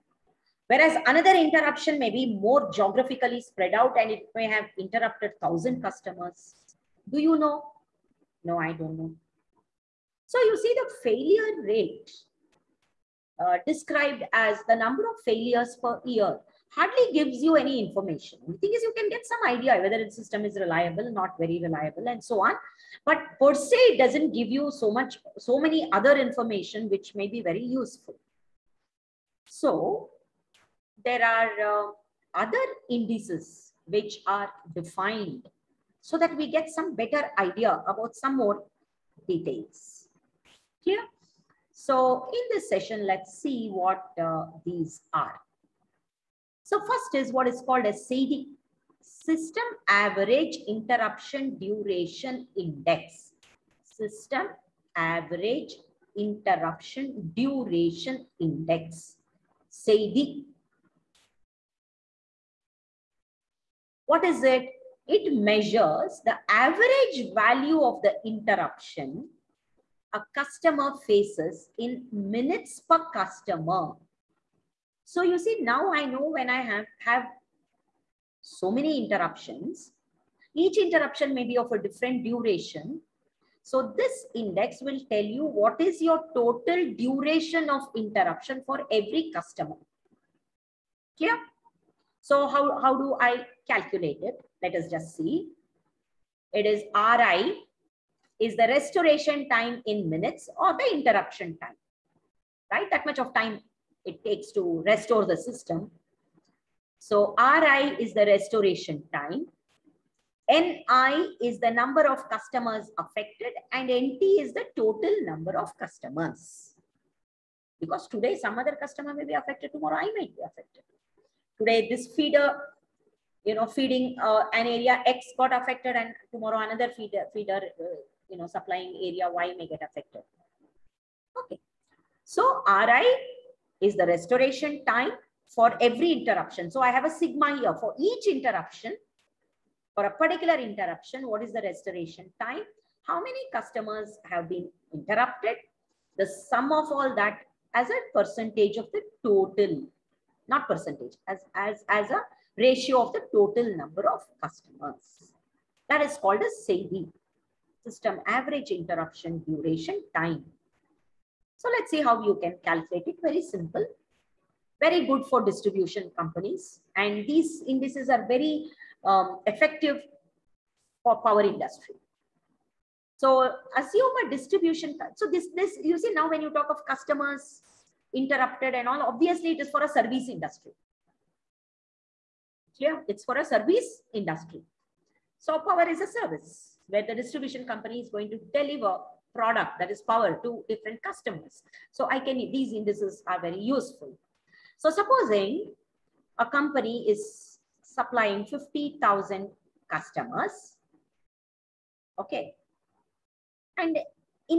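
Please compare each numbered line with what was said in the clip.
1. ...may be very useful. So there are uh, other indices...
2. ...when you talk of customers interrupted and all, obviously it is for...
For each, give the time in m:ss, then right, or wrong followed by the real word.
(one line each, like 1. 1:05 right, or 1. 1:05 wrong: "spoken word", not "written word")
1. 0:27 right
2. 2:56 right.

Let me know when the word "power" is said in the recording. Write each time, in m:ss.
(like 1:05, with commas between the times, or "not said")
2:51, 3:05, 3:10.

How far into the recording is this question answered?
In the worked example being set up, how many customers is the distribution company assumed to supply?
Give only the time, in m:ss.
3:18.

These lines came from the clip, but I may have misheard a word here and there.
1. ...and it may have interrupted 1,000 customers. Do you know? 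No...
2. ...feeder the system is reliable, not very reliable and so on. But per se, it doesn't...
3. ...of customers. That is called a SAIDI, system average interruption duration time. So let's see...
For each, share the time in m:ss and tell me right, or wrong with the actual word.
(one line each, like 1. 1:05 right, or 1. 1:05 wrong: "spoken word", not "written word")
1. 0:03 right
2. 0:19 wrong: "whether", not "feeder"
3. 2:34 right.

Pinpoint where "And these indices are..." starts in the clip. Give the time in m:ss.
2:46.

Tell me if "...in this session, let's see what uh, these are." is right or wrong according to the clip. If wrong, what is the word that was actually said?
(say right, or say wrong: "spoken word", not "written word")
right.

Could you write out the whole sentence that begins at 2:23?
How many customers have been interrupted?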